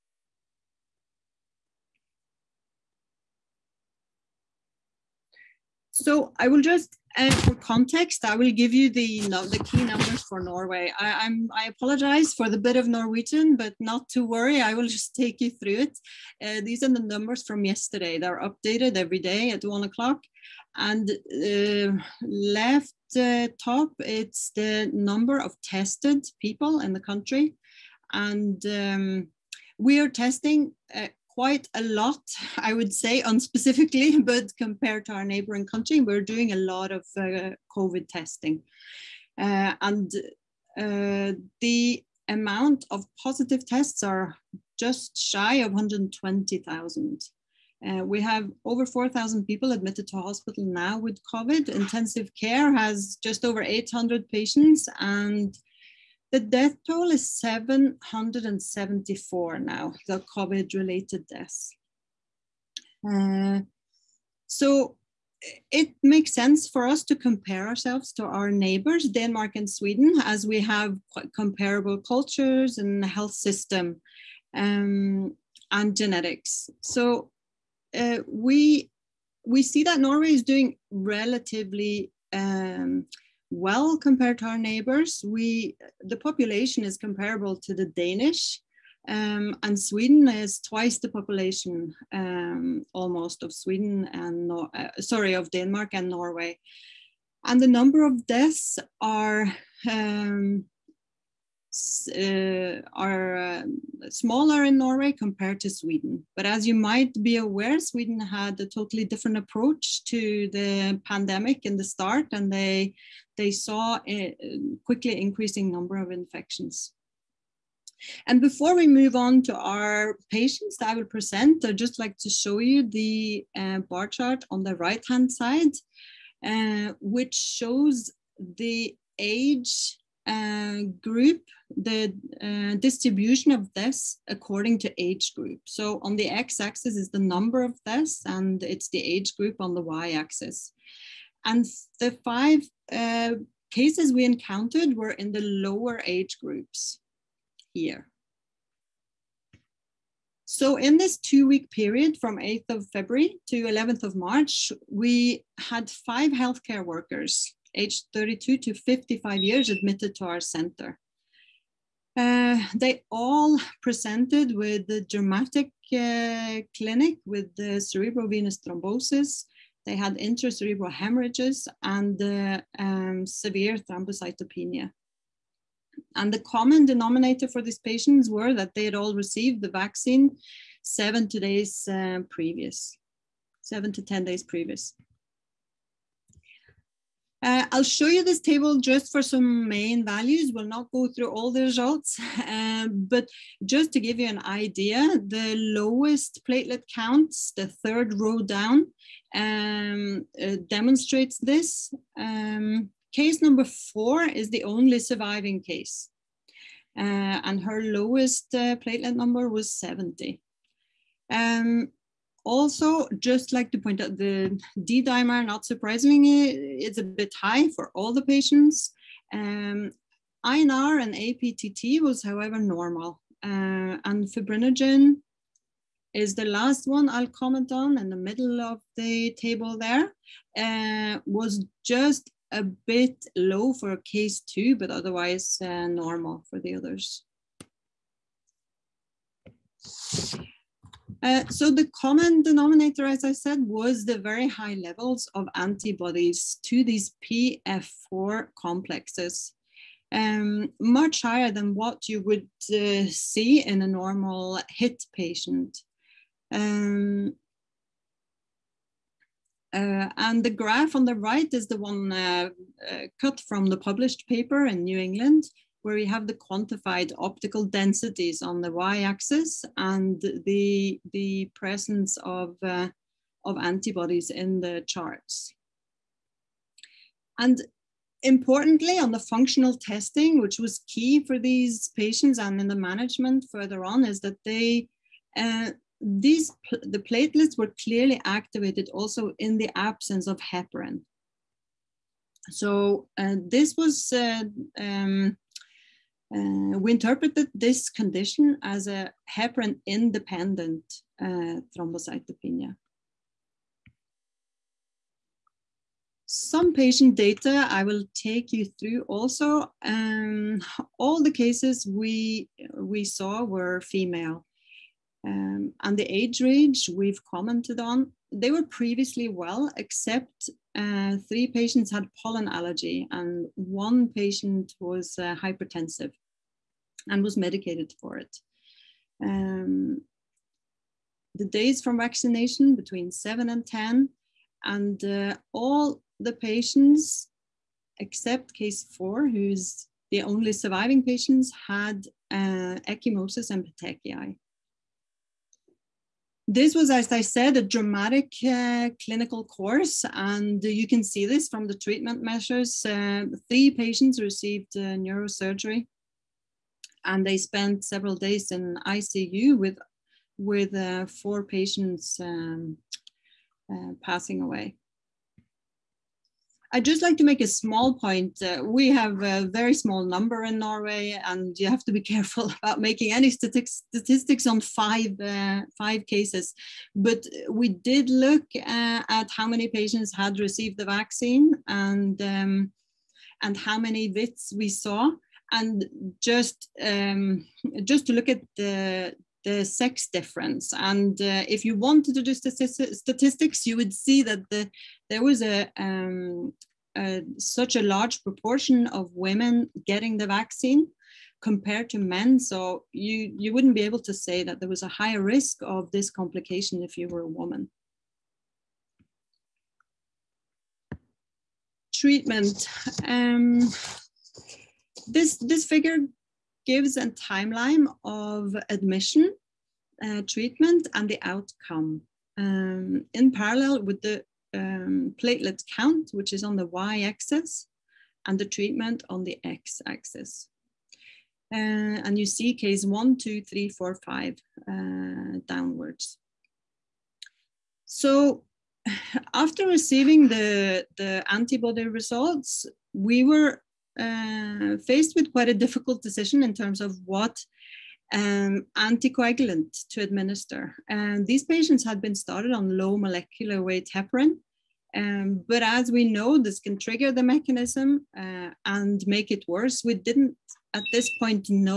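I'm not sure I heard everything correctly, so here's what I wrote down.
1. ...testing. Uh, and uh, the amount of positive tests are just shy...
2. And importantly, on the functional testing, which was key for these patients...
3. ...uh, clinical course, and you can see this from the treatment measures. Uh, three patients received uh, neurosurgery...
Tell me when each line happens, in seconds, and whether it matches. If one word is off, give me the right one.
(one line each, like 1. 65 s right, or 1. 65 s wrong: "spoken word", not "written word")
1. 38 s right
2. 277 s right
3. 348 s right.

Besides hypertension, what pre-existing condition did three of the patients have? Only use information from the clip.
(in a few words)
pollen allergy.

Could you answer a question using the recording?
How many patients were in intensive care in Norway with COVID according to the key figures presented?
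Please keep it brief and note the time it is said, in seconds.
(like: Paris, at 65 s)
just over 800, at 53 s.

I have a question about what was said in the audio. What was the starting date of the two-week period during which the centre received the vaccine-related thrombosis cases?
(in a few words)
8th of February.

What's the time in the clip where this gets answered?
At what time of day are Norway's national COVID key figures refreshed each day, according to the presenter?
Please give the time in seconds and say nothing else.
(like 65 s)
19 s.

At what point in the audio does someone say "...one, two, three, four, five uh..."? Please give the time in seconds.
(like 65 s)
432 s.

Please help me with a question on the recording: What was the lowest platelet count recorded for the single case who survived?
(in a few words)
70.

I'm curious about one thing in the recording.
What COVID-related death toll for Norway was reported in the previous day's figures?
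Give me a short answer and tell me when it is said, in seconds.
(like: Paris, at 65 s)
774, at 57 s.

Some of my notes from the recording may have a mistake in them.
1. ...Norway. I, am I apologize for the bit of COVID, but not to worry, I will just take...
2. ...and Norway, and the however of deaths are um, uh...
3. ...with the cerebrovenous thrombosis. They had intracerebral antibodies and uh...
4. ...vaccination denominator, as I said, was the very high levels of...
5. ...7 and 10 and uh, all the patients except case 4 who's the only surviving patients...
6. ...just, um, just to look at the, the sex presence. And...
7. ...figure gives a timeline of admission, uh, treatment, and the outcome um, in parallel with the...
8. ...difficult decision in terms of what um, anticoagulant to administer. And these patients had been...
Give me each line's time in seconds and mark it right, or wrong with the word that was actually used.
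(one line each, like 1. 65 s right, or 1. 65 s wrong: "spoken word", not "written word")
1. 10 s wrong: "Norwegian", not "COVID"
2. 95 s wrong: "number", not "however"
3. 167 s wrong: "hemorrhages", not "antibodies"
4. 241 s wrong: "common", not "vaccination"
5. 333 s right
6. 386 s wrong: "difference", not "presence"
7. 415 s right
8. 445 s right.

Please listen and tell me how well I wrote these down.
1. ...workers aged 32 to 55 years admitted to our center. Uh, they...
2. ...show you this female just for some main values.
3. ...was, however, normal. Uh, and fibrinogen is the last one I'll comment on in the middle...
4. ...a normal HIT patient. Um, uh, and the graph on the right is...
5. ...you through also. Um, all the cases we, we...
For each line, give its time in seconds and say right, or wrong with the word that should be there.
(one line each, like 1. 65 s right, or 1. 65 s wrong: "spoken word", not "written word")
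1. 156 s right
2. 187 s wrong: "table", not "female"
3. 222 s right
4. 253 s right
5. 308 s right.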